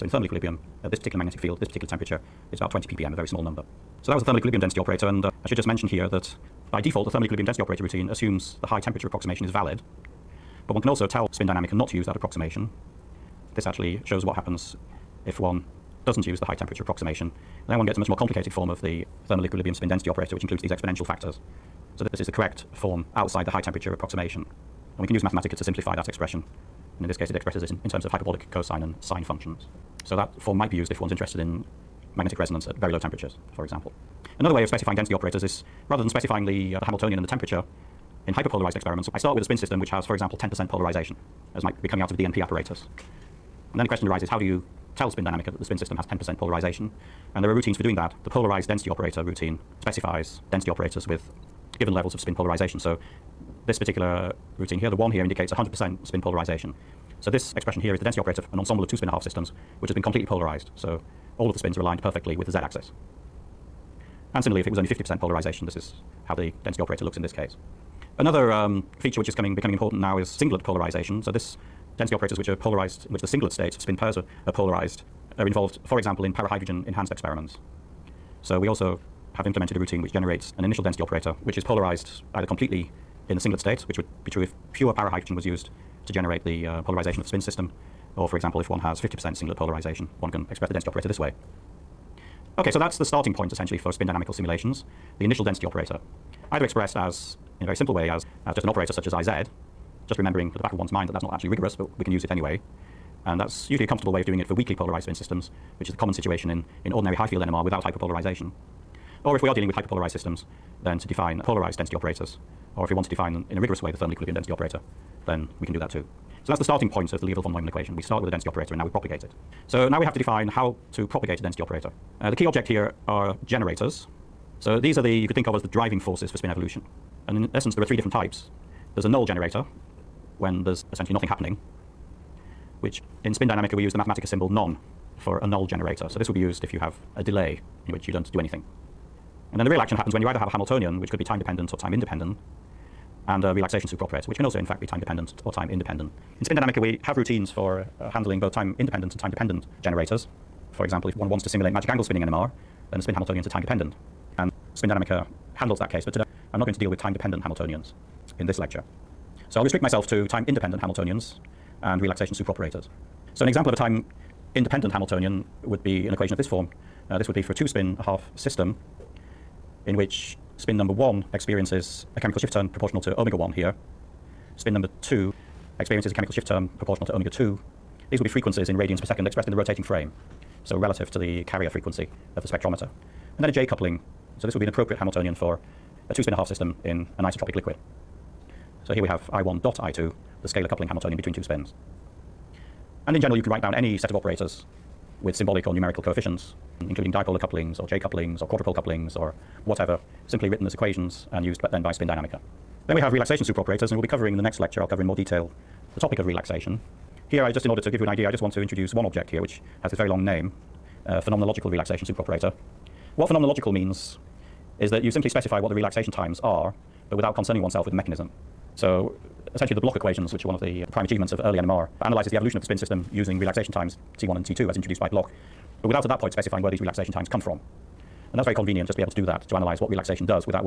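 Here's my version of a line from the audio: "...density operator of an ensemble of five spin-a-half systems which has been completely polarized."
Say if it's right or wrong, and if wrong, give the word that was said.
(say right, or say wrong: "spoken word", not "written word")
wrong: "two", not "five".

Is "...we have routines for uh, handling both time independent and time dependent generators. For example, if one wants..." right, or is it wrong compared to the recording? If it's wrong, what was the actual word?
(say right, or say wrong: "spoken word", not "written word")
right.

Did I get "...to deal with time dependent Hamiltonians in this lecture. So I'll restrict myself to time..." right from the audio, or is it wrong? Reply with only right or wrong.
right.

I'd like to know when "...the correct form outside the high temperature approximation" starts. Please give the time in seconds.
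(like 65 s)
22 s.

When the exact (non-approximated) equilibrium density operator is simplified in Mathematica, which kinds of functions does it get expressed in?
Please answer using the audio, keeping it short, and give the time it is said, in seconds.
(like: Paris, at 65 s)
hyperbolic cosine and sine, at 28 s.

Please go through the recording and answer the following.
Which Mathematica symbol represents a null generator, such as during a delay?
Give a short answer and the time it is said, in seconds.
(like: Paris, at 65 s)
None, at 134 s.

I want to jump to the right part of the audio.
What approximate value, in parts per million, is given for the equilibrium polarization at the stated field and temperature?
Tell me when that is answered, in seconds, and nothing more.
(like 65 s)
2 s.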